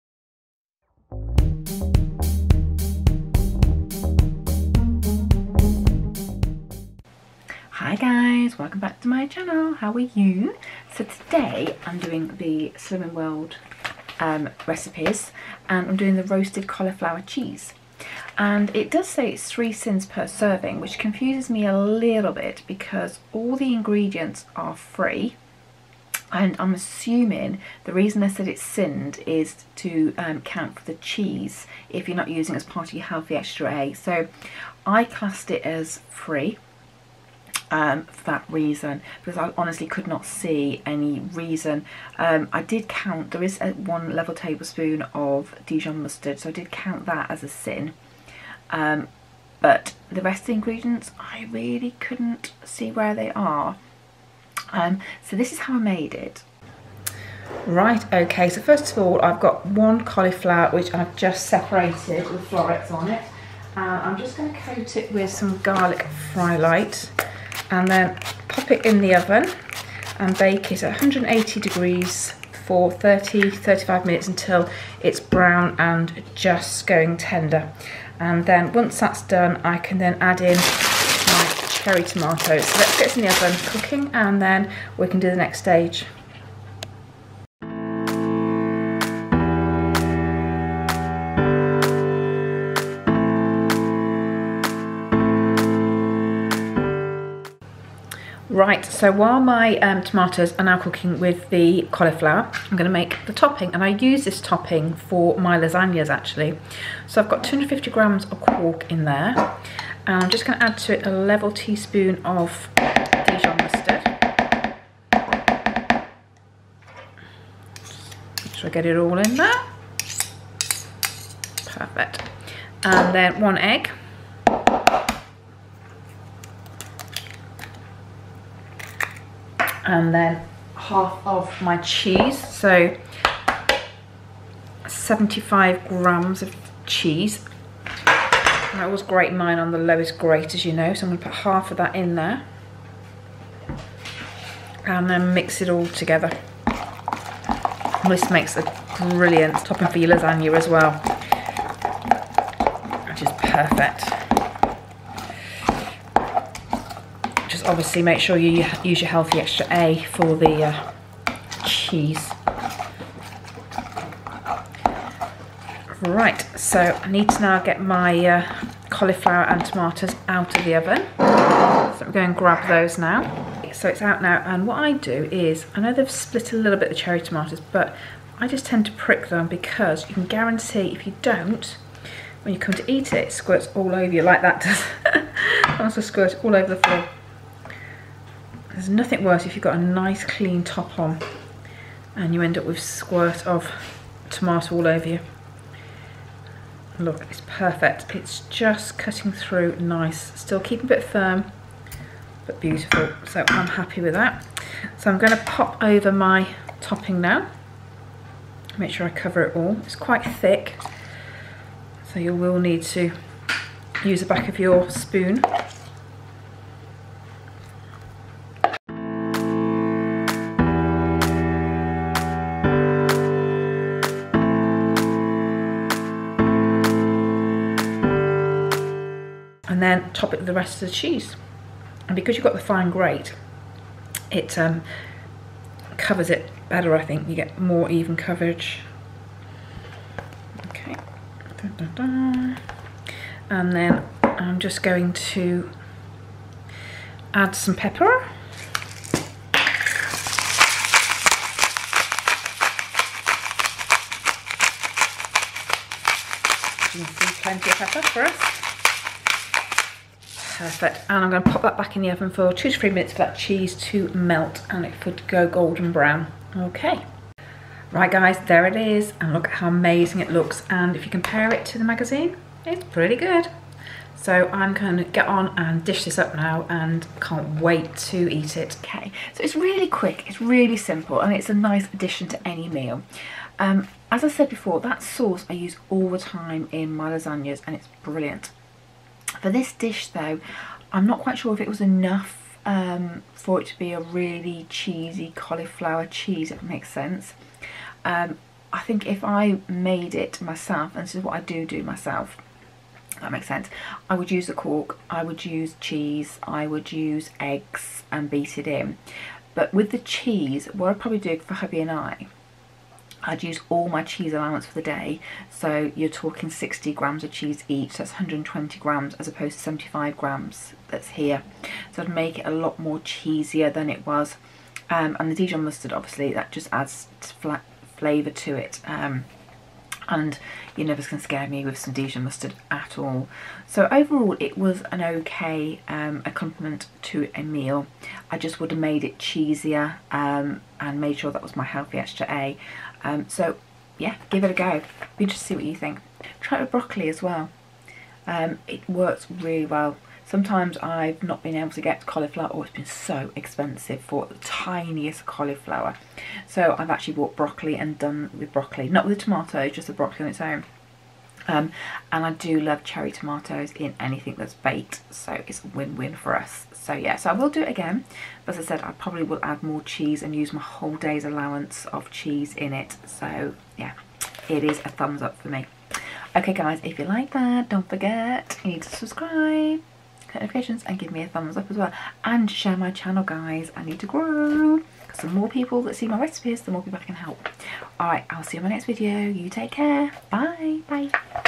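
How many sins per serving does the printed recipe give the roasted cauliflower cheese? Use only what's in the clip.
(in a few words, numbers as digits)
3.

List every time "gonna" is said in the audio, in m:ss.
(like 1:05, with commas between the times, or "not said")
2:21, 3:25.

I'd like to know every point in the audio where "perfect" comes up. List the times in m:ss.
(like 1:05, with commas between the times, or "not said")
2:01, 2:33, 3:17, 4:20.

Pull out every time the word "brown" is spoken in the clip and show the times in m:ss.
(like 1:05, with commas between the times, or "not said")
1:15, 4:25.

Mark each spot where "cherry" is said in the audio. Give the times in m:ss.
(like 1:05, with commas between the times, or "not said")
1:21, 2:56, 6:02.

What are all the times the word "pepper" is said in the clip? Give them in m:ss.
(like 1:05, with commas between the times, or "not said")
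4:07, 4:17.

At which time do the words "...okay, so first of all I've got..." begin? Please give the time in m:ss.
0:58.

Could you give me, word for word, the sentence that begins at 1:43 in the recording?
And I use this topping for my lasagnas, actually.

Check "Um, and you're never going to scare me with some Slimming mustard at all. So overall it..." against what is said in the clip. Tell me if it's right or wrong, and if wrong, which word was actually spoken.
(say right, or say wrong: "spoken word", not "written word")
wrong: "Dijon", not "Slimming".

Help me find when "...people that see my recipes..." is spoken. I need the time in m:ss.
6:25.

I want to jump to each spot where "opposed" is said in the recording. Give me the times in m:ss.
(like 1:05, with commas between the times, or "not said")
5:19.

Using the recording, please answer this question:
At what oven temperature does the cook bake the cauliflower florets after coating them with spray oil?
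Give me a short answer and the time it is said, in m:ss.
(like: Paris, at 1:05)
180 degrees, at 1:10.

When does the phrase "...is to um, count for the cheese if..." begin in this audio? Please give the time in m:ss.
0:29.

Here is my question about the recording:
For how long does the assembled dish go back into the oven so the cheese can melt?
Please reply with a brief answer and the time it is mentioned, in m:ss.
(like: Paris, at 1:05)
2 to 3 minutes, at 4:22.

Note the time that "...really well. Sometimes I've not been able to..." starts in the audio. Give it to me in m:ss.
5:49.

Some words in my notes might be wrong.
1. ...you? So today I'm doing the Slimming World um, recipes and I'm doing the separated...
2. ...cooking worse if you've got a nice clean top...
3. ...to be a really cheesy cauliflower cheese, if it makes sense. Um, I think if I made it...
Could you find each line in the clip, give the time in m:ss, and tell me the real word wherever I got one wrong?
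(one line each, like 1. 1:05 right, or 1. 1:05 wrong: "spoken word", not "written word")
1. 0:09 wrong: "roasted", not "separated"
2. 3:08 wrong: "nothing", not "cooking"
3. 4:53 right.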